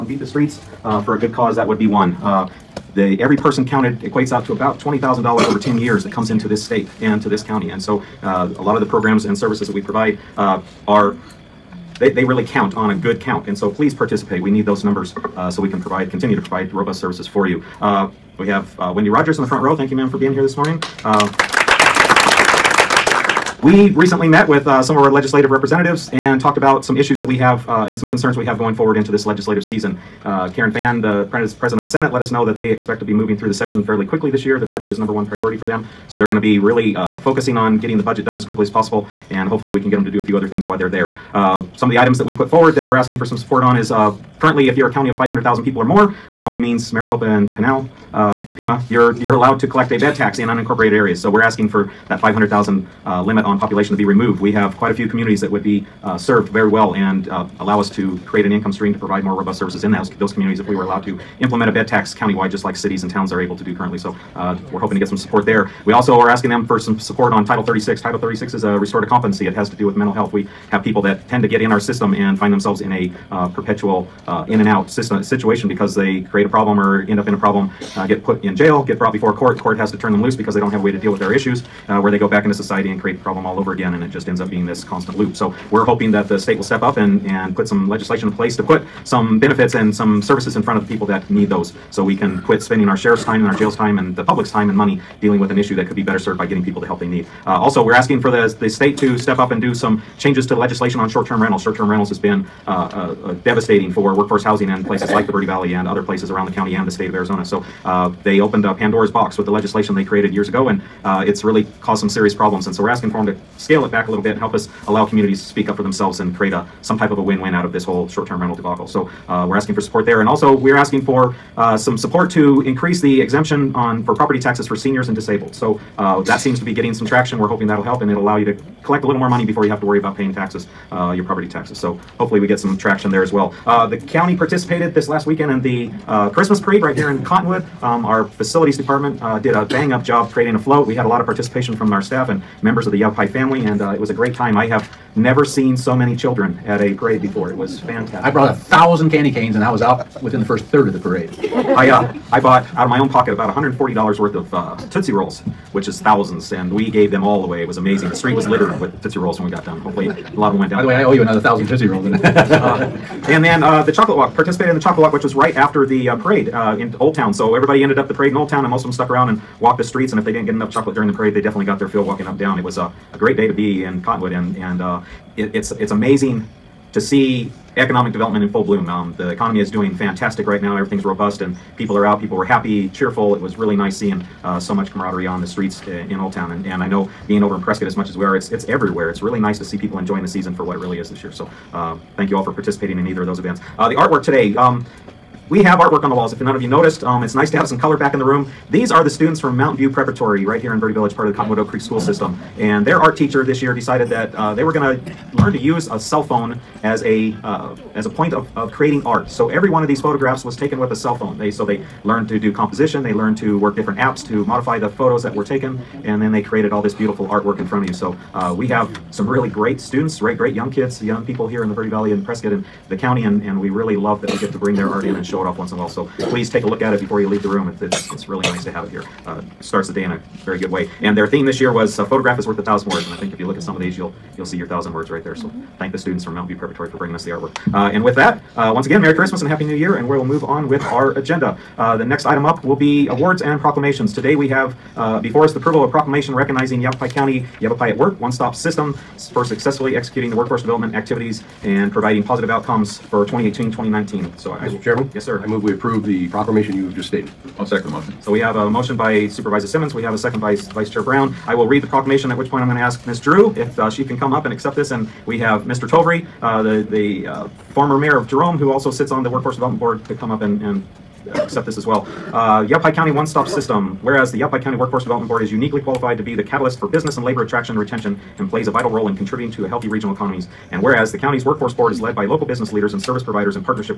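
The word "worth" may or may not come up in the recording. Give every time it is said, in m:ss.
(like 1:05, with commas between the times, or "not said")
2:34, 3:52.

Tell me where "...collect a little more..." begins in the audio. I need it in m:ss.
2:08.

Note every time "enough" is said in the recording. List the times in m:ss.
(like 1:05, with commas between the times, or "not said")
2:50.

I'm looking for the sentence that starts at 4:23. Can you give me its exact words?
Drew if uh, she can come up and accept this.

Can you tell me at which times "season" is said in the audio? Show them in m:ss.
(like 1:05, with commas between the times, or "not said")
0:29, 3:10.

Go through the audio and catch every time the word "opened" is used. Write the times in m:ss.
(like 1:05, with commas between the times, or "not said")
1:48.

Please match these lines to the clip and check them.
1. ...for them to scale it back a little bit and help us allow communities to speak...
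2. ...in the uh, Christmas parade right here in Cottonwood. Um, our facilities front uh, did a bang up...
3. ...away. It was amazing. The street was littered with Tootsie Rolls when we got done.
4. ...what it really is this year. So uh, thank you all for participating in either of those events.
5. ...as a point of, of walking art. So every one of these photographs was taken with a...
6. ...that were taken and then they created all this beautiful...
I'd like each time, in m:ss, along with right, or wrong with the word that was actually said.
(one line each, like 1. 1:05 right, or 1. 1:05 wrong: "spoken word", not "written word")
1. 1:53 right
2. 2:15 wrong: "department", not "front"
3. 2:37 right
4. 3:10 right
5. 3:27 wrong: "creating", not "walking"
6. 3:35 right.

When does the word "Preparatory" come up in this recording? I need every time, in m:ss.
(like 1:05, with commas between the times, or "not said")
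3:19, 3:56.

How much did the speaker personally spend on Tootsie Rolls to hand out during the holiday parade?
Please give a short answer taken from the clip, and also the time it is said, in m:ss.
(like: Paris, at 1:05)
$140, at 2:33.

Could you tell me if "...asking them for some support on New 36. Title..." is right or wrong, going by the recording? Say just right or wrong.
wrong.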